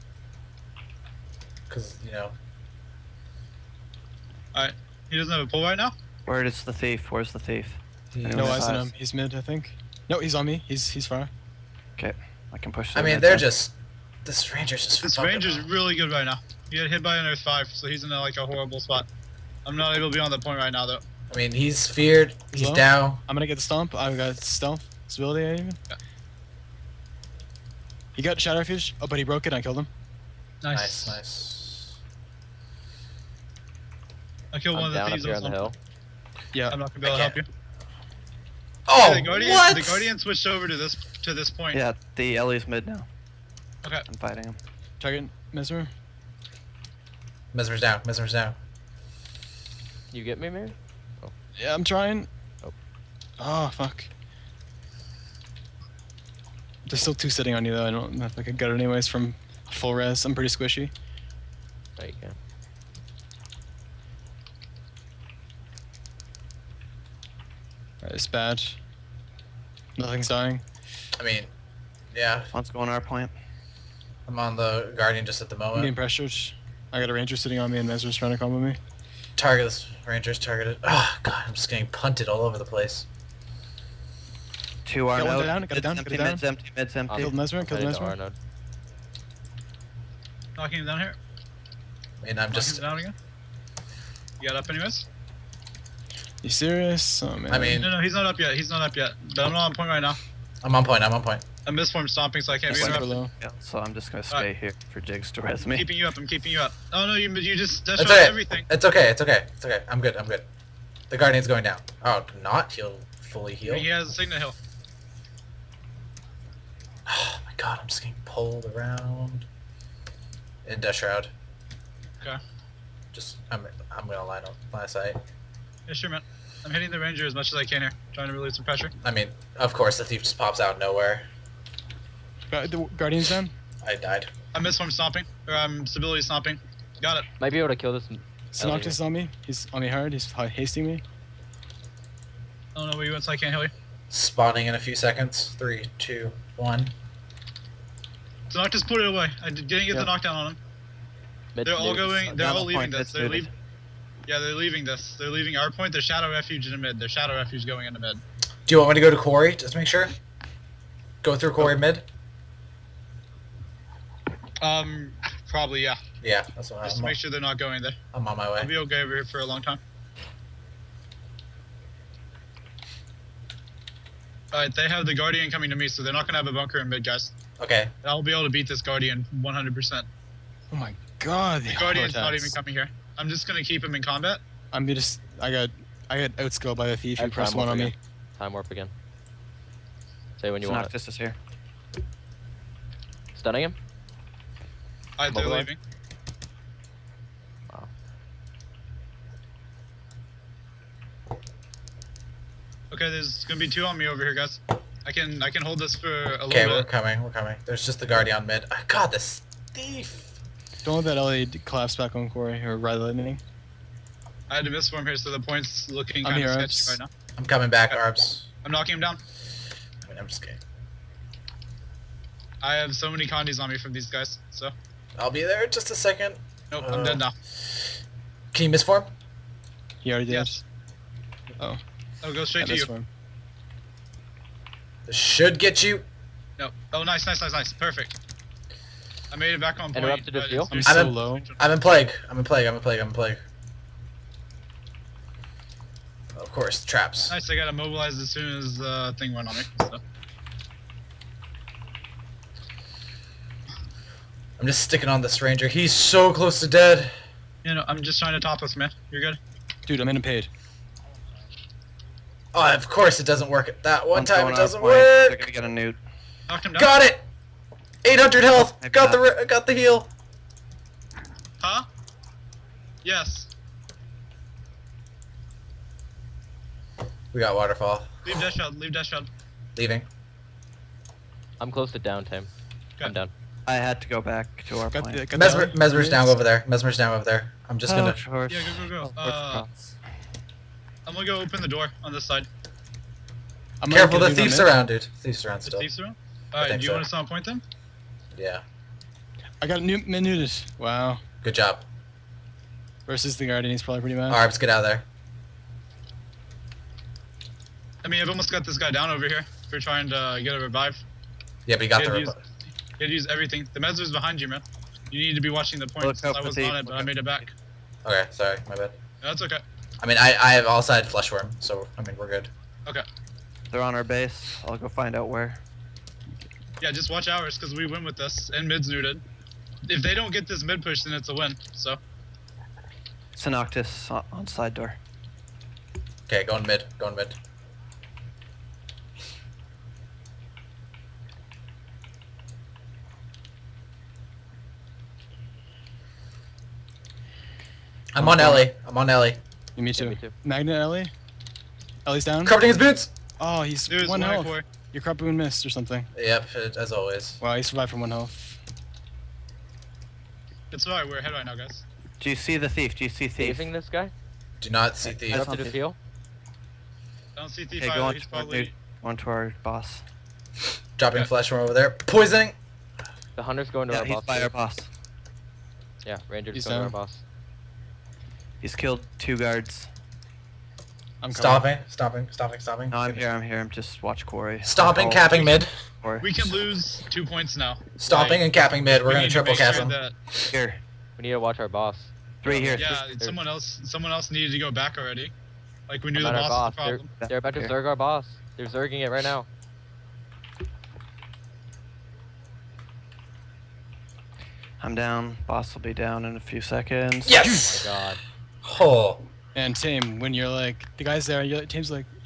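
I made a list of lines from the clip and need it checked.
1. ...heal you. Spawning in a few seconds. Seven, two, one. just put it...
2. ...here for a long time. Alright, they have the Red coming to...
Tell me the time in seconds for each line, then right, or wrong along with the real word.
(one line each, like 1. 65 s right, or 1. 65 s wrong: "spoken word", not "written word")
1. 143 s wrong: "Three", not "Seven"
2. 169 s wrong: "Guardian", not "Red".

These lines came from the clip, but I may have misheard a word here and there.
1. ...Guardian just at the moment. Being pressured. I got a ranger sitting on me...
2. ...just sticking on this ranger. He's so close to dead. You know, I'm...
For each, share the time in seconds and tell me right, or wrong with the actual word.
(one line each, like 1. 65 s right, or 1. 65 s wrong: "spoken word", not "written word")
1. 74 s right
2. 254 s right.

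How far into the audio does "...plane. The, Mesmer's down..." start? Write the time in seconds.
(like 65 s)
285 s.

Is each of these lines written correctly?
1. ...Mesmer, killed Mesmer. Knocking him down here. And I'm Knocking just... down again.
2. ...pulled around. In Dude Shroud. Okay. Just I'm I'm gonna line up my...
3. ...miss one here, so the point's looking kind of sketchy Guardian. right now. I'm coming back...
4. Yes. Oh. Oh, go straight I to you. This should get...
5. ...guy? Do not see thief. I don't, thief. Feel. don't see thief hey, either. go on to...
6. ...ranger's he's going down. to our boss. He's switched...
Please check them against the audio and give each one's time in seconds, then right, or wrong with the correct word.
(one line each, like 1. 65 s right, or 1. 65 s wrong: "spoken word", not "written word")
1. 87 s right
2. 118 s wrong: "Death", not "Dude"
3. 214 s wrong: "Arbs", not "Guardian"
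4. 230 s right
5. 363 s right
6. 376 s wrong: "killed", not "switched".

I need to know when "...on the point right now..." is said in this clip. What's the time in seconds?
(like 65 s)
20 s.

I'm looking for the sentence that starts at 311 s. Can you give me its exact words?
Yeah, but he got the revive.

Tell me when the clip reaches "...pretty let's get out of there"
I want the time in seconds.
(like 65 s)
304 s.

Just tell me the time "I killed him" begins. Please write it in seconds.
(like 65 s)
29 s.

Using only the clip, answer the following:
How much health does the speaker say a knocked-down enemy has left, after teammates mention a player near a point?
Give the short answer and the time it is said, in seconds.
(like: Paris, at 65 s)
800 health, at 268 s.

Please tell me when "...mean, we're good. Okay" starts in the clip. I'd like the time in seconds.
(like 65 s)
322 s.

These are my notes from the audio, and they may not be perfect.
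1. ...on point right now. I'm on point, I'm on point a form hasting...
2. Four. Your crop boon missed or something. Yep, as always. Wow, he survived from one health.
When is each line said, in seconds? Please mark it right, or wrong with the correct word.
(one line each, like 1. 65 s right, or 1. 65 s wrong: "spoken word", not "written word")
1. 99 s wrong: "stomping", not "hasting"
2. 354 s right.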